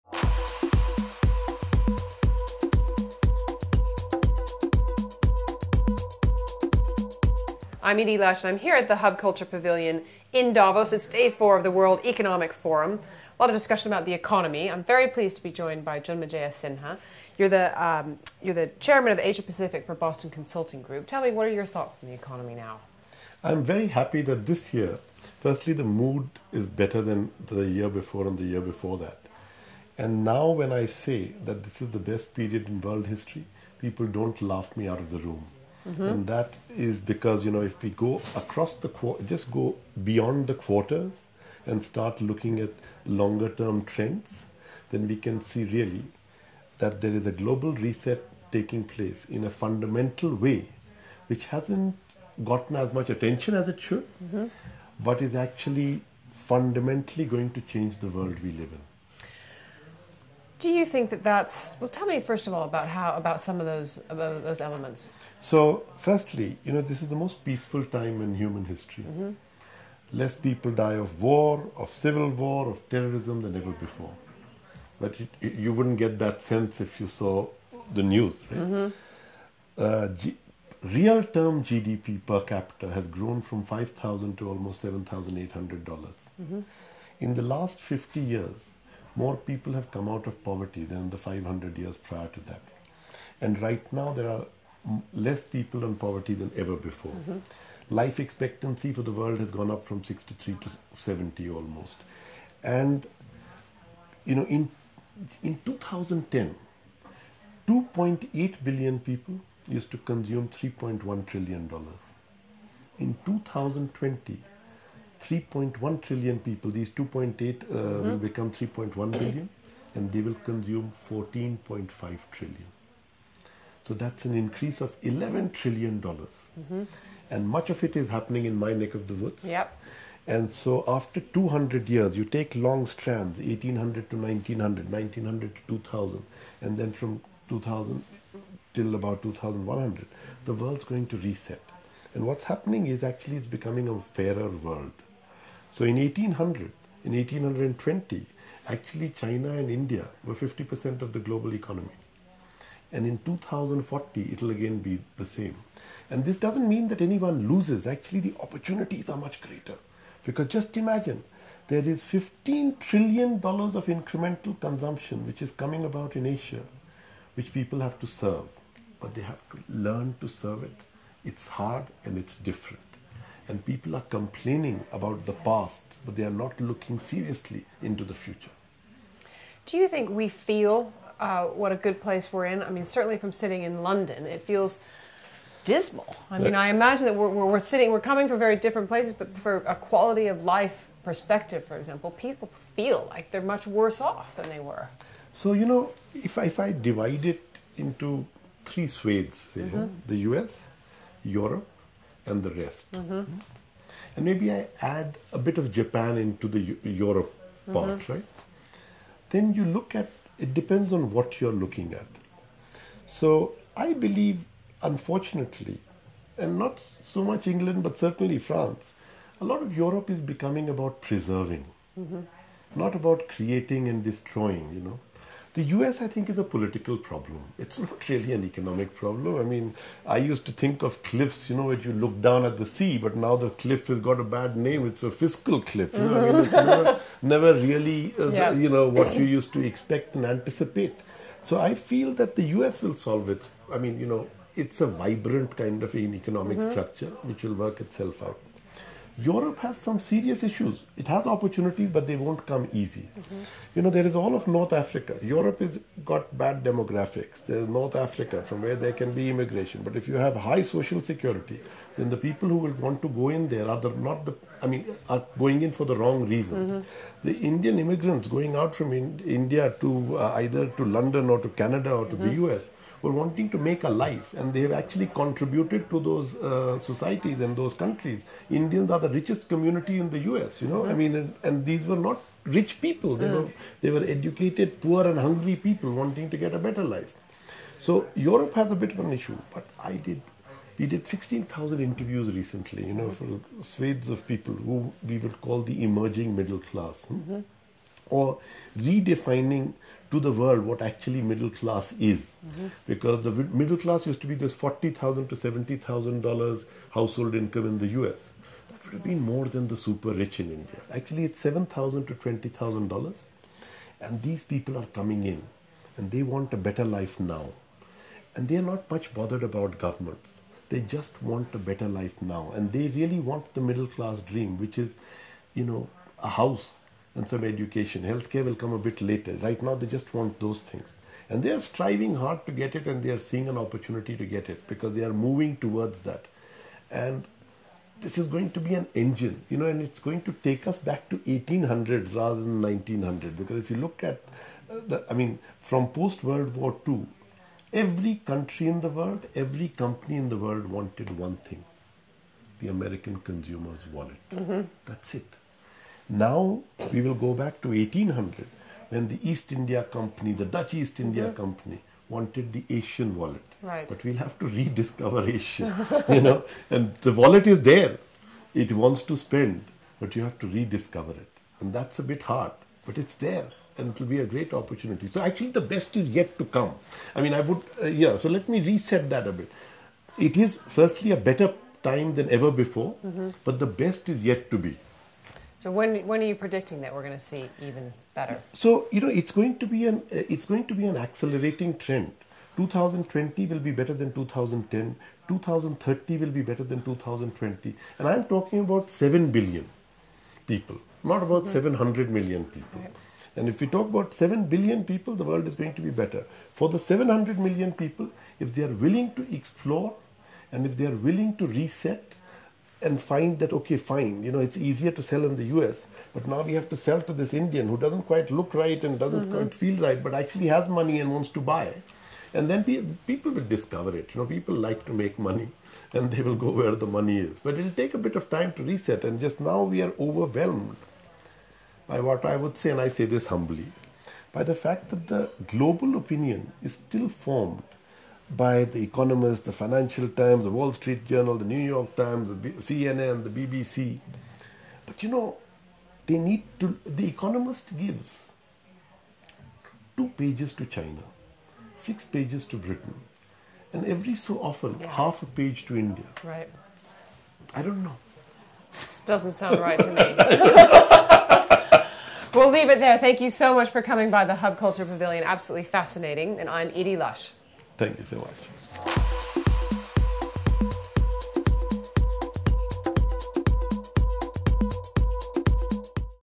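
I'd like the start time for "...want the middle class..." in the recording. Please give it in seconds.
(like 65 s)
323 s.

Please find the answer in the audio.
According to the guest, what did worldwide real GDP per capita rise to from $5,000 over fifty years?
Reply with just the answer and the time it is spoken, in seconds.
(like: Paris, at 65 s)
$7,800, at 84 s.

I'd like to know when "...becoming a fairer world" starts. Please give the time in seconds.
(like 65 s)
143 s.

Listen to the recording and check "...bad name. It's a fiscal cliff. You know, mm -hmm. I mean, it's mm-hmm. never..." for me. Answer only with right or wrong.
right.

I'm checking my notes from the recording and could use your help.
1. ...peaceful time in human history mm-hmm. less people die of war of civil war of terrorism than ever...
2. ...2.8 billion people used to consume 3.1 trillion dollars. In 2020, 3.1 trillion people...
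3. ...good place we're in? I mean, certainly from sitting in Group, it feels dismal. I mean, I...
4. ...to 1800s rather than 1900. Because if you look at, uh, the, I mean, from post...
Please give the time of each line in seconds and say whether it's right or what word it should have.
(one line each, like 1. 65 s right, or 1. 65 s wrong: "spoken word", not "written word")
1. 67 s right
2. 107 s right
3. 181 s wrong: "London", not "Group"
4. 341 s right.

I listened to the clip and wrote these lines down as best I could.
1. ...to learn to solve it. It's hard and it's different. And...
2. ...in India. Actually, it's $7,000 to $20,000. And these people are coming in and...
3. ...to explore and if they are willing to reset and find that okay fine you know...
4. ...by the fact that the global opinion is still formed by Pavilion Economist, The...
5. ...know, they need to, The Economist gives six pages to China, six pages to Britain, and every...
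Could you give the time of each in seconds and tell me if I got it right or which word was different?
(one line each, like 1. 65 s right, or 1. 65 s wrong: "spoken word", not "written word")
1. 169 s wrong: "serve", not "solve"
2. 310 s right
3. 409 s right
4. 434 s wrong: "The", not "Pavilion"
5. 445 s wrong: "two", not "six".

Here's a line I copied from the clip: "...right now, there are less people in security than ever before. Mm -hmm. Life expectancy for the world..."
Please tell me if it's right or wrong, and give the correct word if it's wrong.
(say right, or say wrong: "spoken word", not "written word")
wrong: "poverty", not "security".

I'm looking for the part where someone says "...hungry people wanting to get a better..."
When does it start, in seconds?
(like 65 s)
285 s.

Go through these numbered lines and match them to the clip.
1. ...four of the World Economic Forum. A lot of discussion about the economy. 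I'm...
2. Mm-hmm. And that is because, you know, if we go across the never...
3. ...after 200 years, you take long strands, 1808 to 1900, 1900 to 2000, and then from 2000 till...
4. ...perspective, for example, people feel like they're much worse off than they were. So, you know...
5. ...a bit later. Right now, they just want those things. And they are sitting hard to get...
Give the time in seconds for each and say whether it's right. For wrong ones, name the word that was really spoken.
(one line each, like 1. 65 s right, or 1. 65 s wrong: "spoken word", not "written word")
1. 11 s right
2. 35 s wrong: "quarter", not "never"
3. 130 s wrong: "1800", not "1808"
4. 191 s right
5. 328 s wrong: "striving", not "sitting".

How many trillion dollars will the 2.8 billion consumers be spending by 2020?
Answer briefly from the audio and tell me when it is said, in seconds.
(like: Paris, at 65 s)
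14.5 trillion, at 121 s.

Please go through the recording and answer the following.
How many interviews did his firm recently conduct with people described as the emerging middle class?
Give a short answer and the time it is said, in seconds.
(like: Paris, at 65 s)
16,000, at 291 s.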